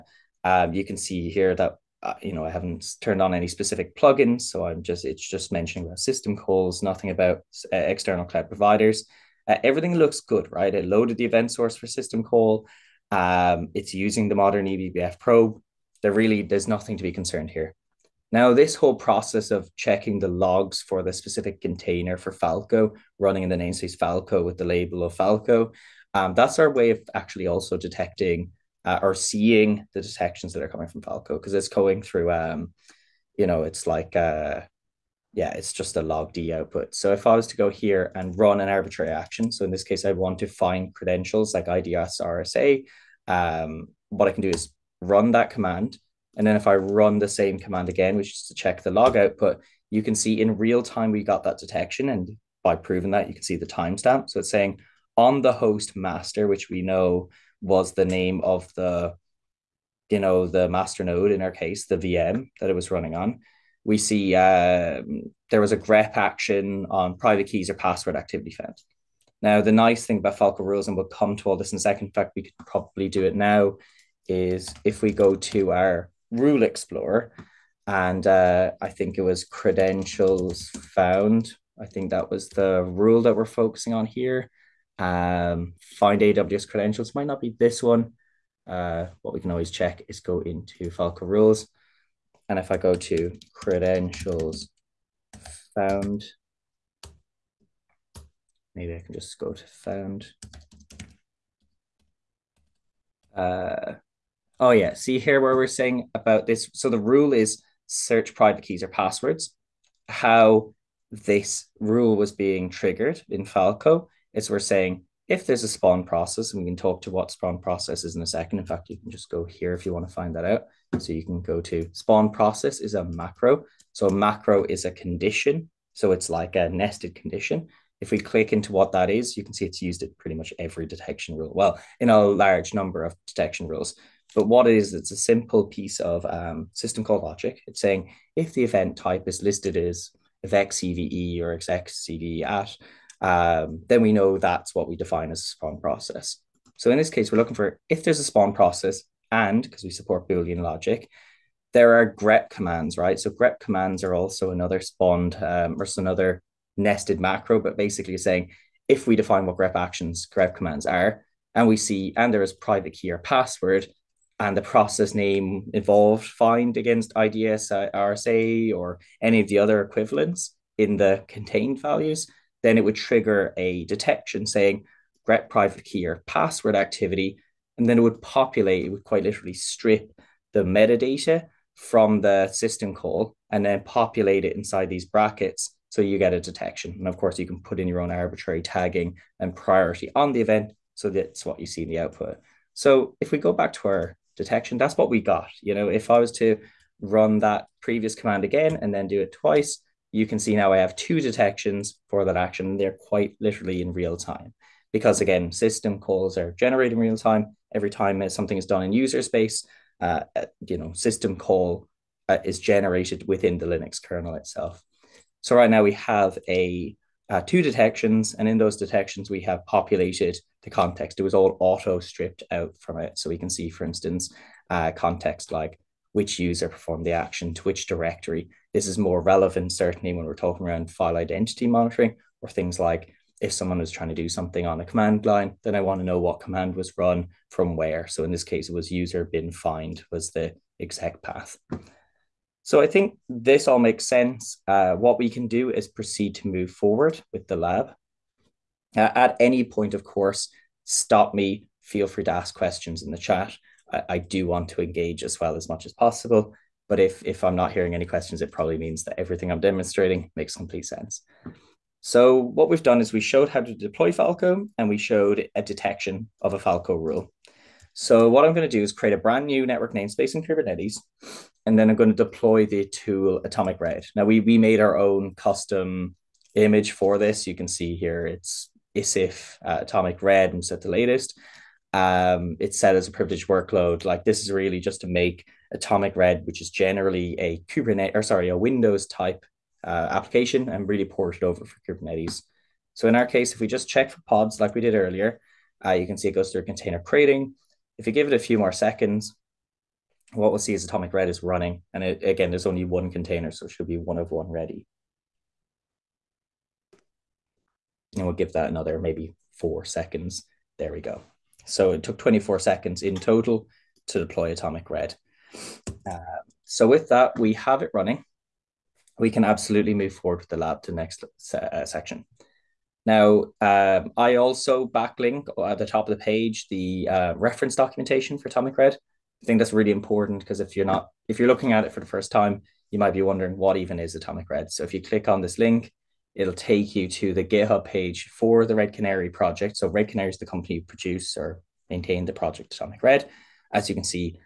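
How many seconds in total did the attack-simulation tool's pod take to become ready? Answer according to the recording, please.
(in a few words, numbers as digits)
24.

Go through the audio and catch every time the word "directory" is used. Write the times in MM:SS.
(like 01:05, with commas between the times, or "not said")
03:47.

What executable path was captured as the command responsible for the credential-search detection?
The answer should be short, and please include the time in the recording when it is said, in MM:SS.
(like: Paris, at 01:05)
user bin find, at 03:58.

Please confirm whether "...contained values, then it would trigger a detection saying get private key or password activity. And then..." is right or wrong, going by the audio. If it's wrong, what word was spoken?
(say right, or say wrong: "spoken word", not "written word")
right.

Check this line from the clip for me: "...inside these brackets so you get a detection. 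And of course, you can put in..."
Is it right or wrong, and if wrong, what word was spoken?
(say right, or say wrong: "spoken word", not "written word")
right.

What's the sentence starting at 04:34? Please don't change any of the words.
Now we, we made our own custom image for this.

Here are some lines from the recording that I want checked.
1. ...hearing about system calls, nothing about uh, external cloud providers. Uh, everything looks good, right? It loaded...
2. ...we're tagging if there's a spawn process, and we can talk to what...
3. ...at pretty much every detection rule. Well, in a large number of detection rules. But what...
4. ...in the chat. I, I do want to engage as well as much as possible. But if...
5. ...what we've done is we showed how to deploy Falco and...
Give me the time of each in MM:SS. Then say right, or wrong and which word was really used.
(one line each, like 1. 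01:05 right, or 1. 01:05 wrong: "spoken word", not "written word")
1. 00:05 wrong: "mentioning", not "hearing"
2. 01:54 wrong: "saying", not "tagging"
3. 02:10 right
4. 04:13 right
5. 04:22 right.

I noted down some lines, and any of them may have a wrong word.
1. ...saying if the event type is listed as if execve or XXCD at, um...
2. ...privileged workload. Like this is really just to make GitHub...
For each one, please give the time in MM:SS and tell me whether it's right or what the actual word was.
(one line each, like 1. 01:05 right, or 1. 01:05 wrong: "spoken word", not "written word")
1. 02:17 right
2. 04:43 wrong: "Atomic", not "GitHub".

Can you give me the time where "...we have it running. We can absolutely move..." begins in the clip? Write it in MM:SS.
05:17.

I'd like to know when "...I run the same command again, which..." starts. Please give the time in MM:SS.
00:46.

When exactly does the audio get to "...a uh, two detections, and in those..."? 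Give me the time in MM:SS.
03:36.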